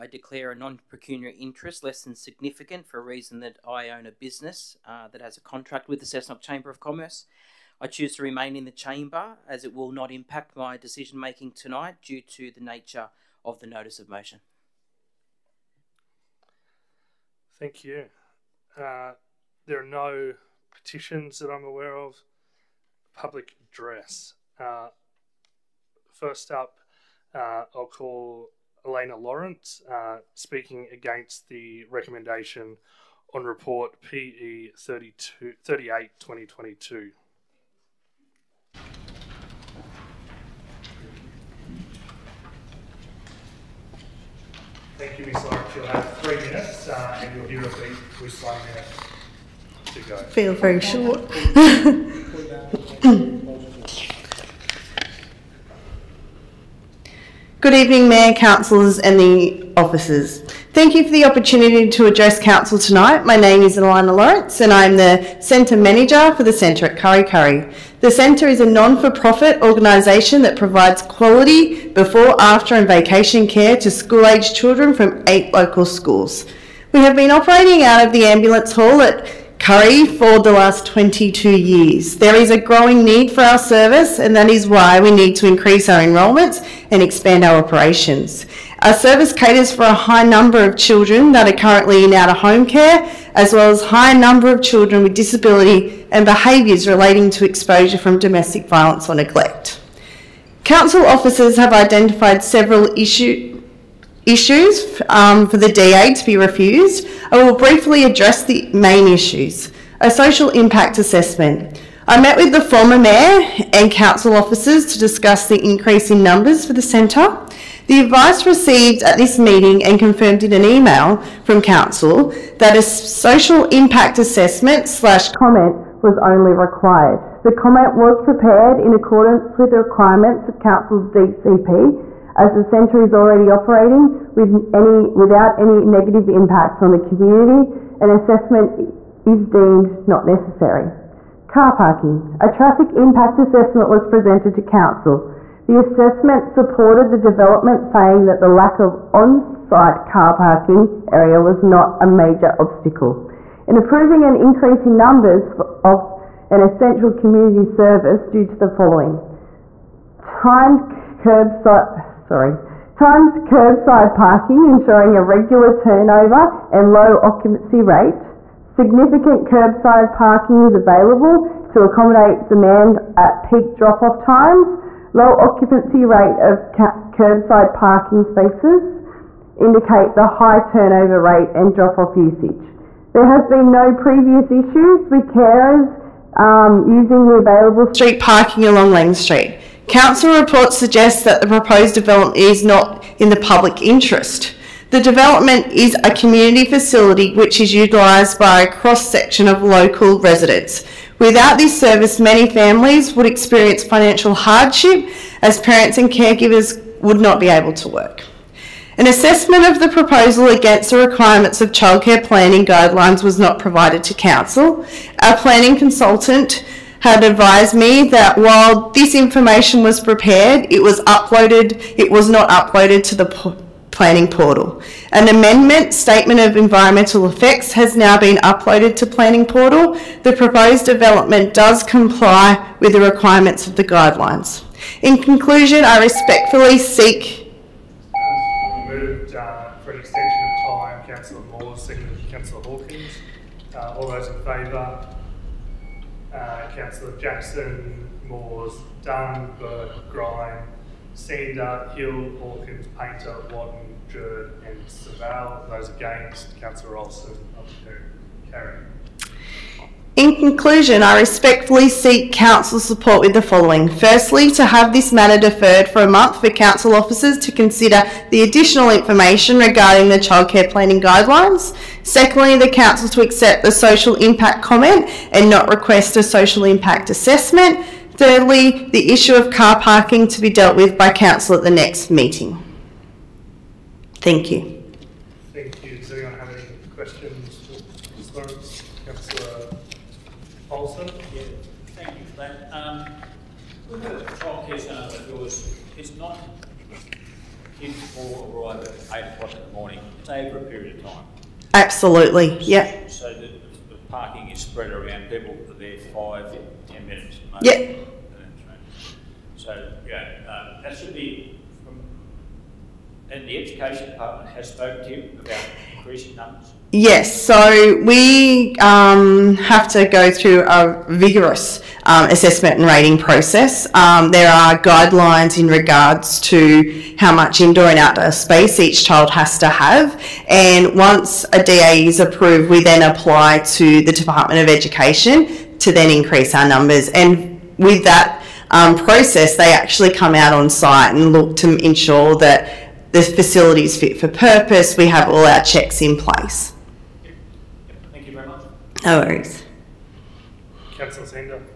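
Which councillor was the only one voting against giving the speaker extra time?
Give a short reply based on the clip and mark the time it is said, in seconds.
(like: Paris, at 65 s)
Olsen, at 256 s.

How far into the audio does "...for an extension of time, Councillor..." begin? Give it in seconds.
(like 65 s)
239 s.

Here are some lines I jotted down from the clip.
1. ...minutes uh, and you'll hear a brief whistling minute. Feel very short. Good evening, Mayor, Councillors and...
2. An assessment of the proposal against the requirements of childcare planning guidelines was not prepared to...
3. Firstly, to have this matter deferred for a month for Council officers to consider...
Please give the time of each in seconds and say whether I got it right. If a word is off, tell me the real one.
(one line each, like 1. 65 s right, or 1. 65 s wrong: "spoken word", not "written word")
1. 46 s right
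2. 208 s wrong: "provided", not "prepared"
3. 263 s right.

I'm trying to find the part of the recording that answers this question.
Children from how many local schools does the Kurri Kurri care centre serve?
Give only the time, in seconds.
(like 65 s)
75 s.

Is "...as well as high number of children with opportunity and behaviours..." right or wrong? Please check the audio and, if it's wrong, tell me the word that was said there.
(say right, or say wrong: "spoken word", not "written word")
wrong: "disability", not "opportunity".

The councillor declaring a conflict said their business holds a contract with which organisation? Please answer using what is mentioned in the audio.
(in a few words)
Cessnock Chamber of Commerce.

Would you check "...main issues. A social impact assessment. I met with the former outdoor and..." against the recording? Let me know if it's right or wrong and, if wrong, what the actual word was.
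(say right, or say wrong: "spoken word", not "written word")
wrong: "mayor", not "outdoor".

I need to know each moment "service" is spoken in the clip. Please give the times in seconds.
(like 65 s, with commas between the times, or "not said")
83 s, 88 s, 157 s, 201 s.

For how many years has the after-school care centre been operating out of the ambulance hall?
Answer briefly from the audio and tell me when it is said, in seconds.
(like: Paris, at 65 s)
22, at 80 s.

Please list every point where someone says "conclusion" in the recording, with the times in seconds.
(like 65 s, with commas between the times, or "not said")
235 s, 260 s.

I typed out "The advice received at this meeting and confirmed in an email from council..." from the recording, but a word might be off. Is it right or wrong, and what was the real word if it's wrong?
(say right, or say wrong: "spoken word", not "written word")
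right.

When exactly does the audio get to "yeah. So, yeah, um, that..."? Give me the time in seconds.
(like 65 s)
307 s.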